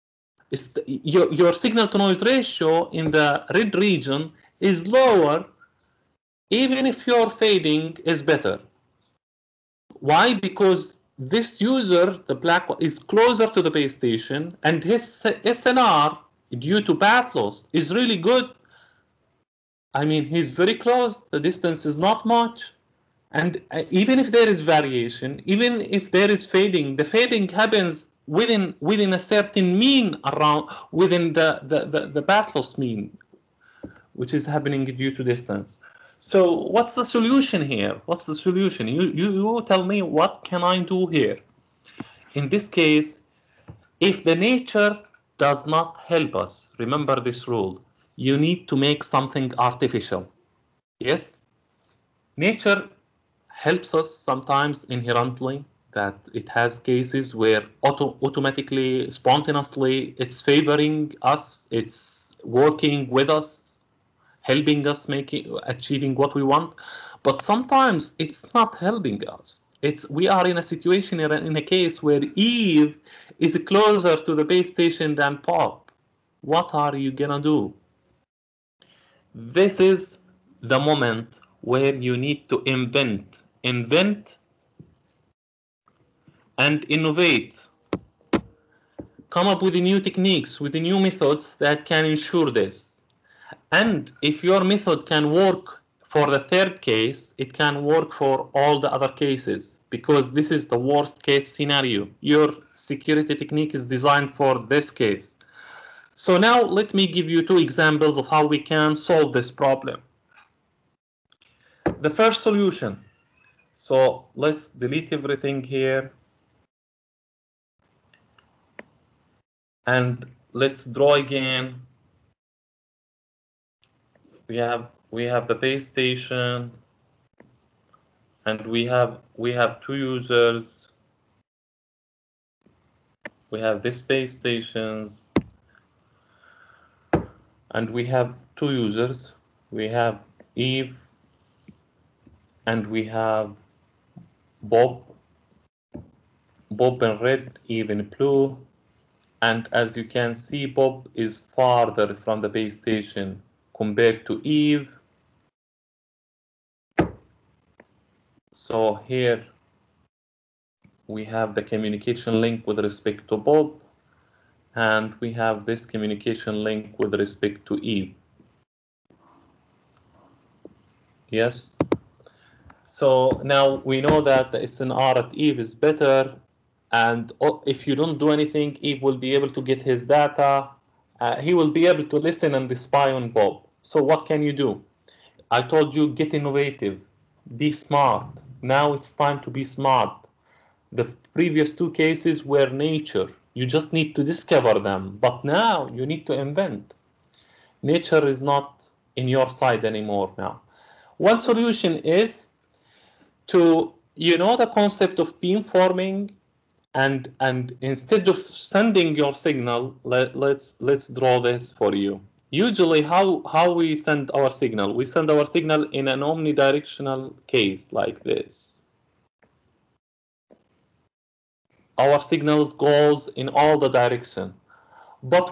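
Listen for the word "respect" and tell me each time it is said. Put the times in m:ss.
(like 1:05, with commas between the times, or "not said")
2:42, 2:47.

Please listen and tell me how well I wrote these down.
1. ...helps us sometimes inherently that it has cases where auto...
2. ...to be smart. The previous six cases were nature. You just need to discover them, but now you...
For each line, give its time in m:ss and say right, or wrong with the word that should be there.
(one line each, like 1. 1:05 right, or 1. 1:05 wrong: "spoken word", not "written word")
1. 0:53 right
2. 3:09 wrong: "two", not "six".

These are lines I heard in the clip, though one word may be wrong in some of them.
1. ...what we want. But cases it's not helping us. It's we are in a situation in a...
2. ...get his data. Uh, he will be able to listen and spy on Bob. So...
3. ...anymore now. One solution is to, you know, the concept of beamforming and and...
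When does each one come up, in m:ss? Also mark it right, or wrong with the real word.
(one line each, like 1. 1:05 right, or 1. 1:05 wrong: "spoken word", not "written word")
1. 1:06 wrong: "sometimes", not "cases"
2. 2:59 right
3. 3:19 right.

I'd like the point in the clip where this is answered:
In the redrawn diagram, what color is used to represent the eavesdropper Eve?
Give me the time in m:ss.
2:28.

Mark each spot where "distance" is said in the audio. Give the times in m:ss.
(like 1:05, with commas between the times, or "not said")
0:21, 0:35.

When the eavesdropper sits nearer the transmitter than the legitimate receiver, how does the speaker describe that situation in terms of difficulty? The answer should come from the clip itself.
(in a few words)
worst case scenario.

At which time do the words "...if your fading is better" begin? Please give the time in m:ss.
0:06.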